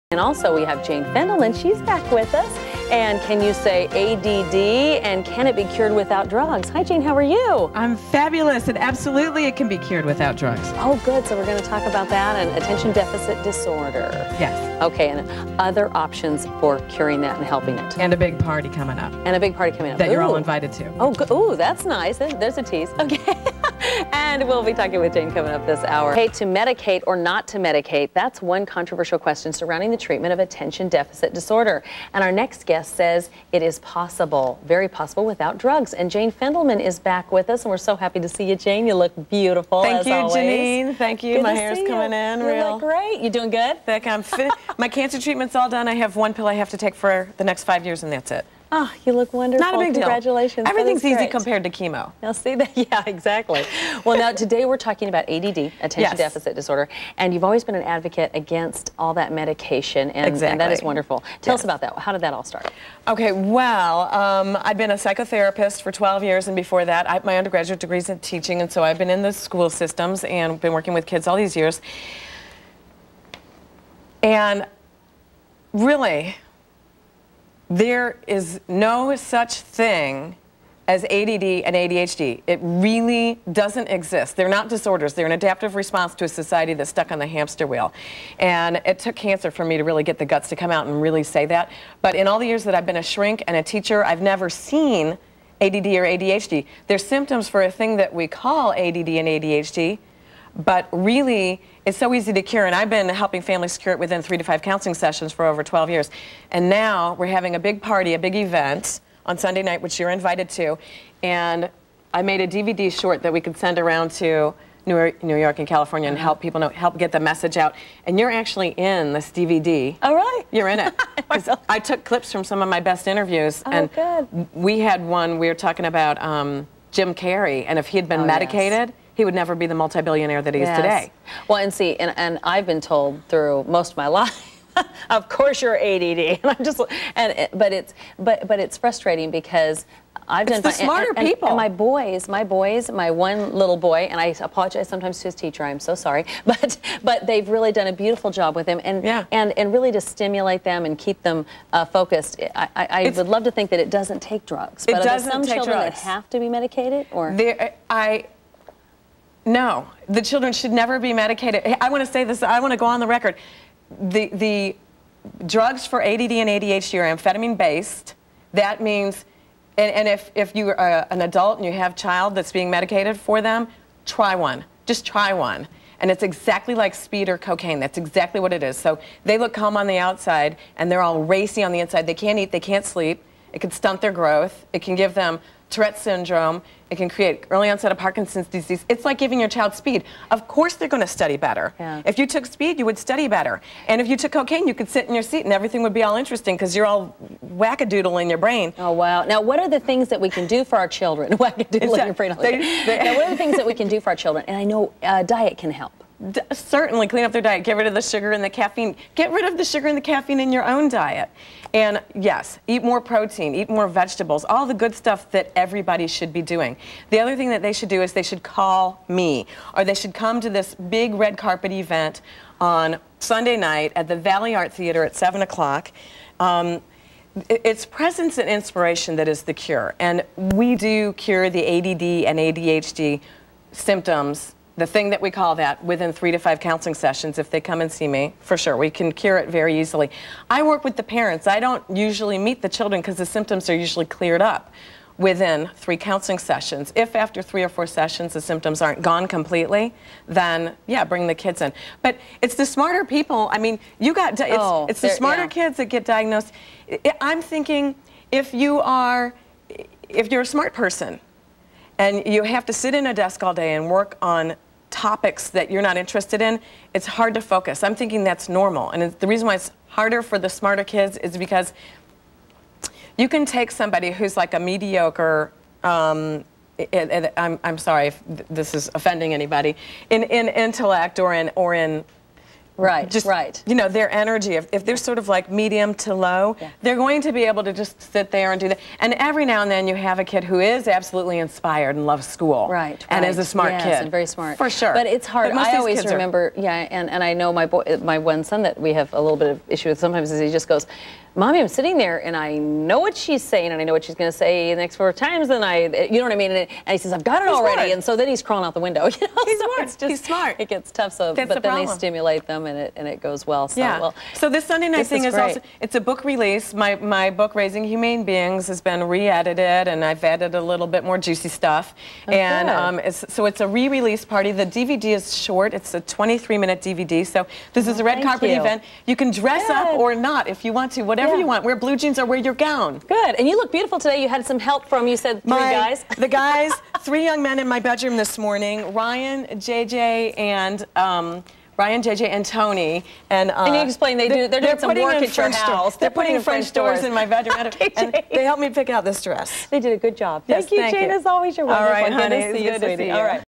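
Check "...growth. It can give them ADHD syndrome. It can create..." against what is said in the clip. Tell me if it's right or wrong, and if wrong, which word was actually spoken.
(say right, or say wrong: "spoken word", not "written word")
wrong: "Tourette", not "ADHD".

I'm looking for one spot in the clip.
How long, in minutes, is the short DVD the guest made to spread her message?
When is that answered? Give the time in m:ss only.
5:26.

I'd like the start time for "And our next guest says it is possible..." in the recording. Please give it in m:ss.
0:32.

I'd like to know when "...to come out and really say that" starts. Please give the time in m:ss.
1:30.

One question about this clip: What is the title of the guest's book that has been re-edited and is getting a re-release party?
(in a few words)
Raising Humane Beings.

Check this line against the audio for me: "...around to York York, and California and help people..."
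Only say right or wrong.
wrong.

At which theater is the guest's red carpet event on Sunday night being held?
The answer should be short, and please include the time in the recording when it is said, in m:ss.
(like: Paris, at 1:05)
Valley Art Theater, at 3:44.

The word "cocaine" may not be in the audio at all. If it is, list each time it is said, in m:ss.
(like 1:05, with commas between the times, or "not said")
2:57, 3:14.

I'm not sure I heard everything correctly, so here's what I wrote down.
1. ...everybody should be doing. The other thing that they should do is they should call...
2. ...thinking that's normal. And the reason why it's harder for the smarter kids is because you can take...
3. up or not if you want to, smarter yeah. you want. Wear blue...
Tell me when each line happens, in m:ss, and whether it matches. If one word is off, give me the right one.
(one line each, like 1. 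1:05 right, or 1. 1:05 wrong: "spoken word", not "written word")
1. 3:35 right
2. 4:27 right
3. 5:29 wrong: "whatever", not "smarter".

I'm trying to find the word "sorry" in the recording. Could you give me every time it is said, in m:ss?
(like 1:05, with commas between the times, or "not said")
2:25, 4:37.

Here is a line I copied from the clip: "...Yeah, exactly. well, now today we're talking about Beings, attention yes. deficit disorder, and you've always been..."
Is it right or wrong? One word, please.
wrong.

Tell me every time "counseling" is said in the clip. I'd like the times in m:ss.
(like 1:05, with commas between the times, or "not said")
1:44, 3:56, 4:05.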